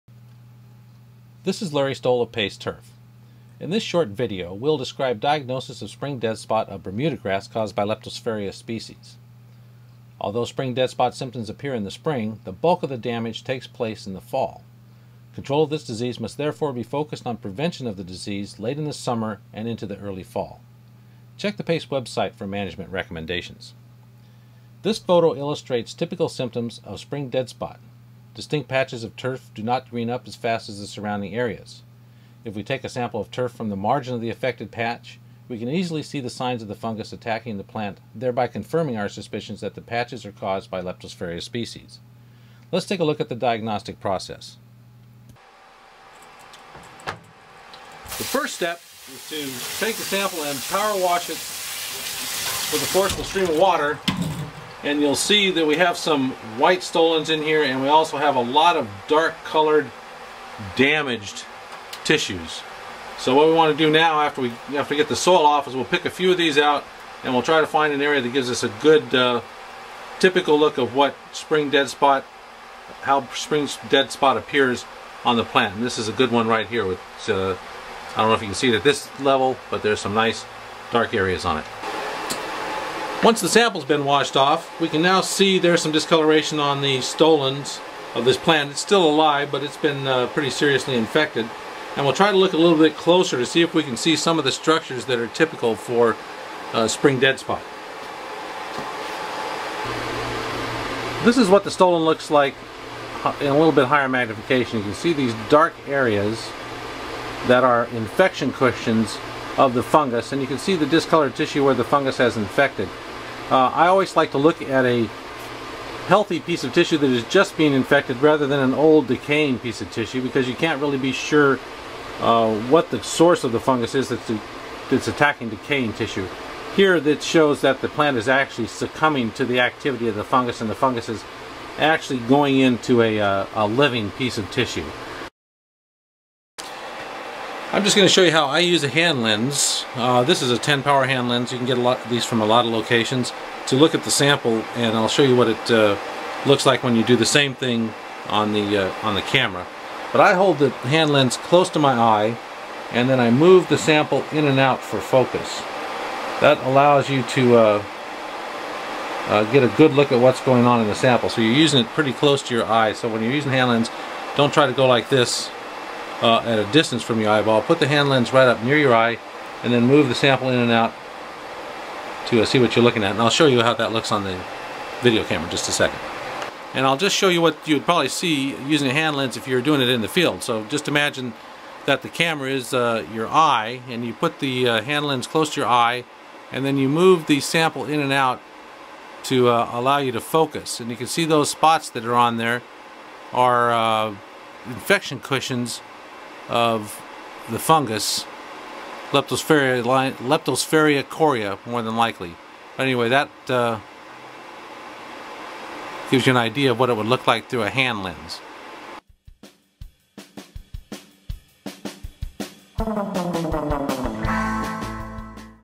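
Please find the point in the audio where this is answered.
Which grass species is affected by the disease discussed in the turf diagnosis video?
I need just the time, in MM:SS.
00:06.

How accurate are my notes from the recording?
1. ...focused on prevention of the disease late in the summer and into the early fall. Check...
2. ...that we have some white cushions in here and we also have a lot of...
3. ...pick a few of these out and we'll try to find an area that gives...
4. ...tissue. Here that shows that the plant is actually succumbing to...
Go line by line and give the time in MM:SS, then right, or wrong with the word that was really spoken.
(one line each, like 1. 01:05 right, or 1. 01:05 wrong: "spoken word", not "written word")
1. 00:16 right
2. 00:55 wrong: "stolons", not "cushions"
3. 01:05 right
4. 02:05 right.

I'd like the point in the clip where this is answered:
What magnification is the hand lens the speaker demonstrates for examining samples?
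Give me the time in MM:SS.
02:20.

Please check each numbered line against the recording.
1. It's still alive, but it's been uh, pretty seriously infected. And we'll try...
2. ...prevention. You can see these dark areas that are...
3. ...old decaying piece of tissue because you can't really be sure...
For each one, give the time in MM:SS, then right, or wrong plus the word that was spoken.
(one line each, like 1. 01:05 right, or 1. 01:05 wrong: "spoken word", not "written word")
1. 01:28 right
2. 01:44 wrong: "magnification", not "prevention"
3. 01:58 right.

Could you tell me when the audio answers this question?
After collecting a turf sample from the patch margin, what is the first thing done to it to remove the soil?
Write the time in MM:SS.
00:50.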